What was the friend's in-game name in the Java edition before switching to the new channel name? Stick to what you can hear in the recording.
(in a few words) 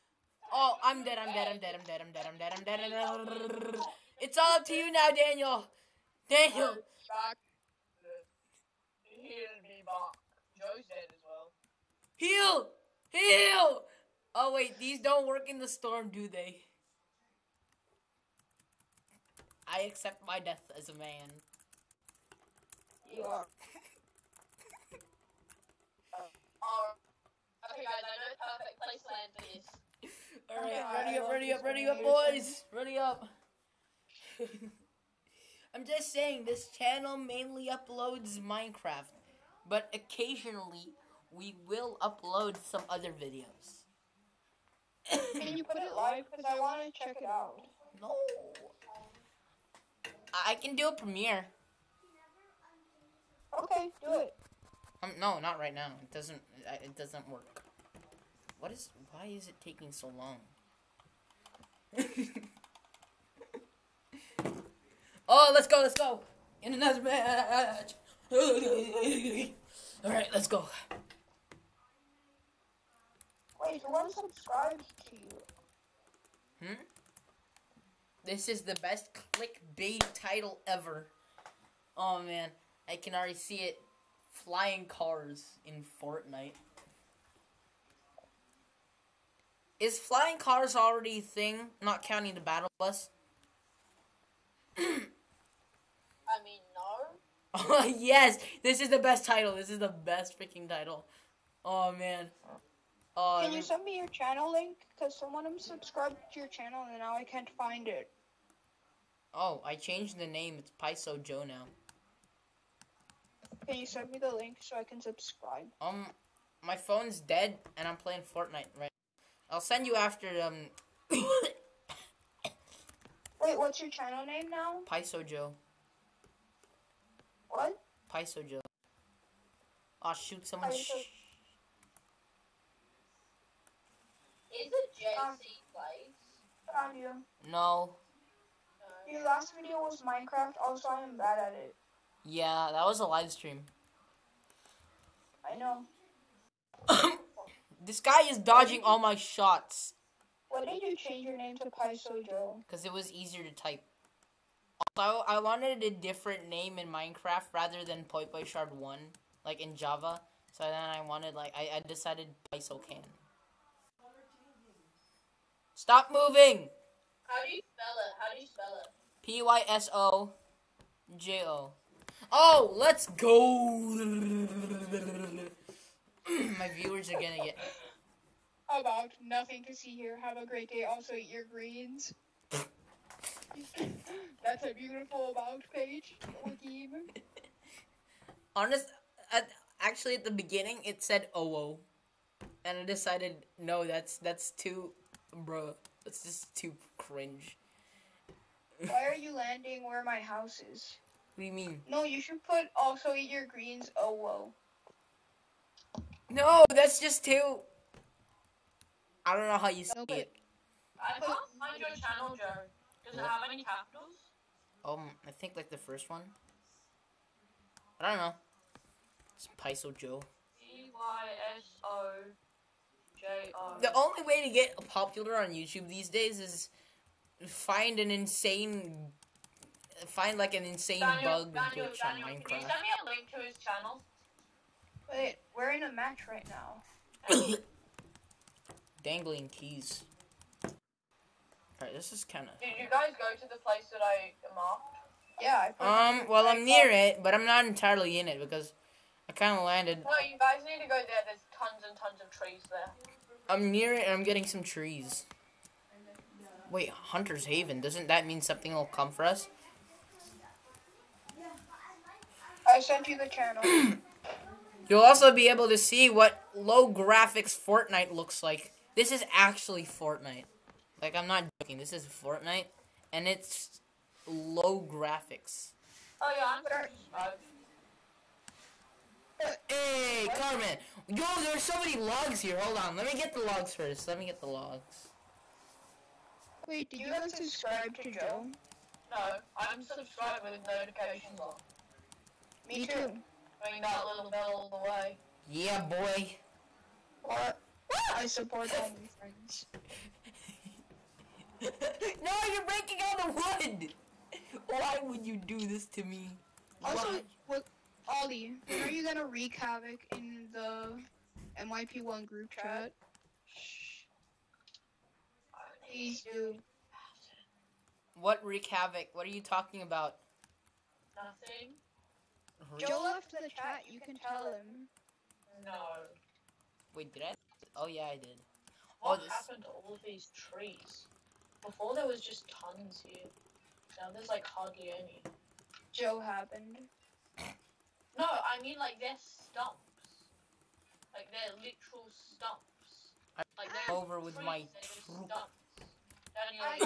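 Poi Shard 1.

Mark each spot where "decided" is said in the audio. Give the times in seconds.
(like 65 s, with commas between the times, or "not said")
161 s, 192 s.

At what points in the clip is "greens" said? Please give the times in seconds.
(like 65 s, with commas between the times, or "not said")
181 s, 203 s.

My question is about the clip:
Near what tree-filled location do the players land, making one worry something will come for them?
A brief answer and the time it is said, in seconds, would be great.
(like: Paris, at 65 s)
Hunter's Haven, at 256 s.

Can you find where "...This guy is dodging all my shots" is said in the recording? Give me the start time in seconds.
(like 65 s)
147 s.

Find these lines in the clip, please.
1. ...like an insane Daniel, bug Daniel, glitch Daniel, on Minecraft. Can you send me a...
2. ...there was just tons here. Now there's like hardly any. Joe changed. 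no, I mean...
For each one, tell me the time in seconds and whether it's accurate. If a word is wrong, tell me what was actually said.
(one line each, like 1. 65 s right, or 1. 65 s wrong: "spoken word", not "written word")
1. 230 s right
2. 331 s wrong: "happened", not "changed".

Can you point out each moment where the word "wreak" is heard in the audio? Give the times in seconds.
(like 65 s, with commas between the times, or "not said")
309 s, 318 s.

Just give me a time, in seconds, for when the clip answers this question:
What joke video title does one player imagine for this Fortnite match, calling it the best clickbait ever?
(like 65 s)
84 s.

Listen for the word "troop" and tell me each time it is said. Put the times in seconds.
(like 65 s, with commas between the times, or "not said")
344 s.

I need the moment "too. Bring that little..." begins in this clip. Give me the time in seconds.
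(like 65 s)
292 s.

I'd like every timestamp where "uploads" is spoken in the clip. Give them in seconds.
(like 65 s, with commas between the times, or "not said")
37 s, 42 s.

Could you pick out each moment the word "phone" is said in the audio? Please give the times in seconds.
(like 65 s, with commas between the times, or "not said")
116 s.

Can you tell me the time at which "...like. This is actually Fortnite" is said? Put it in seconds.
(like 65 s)
268 s.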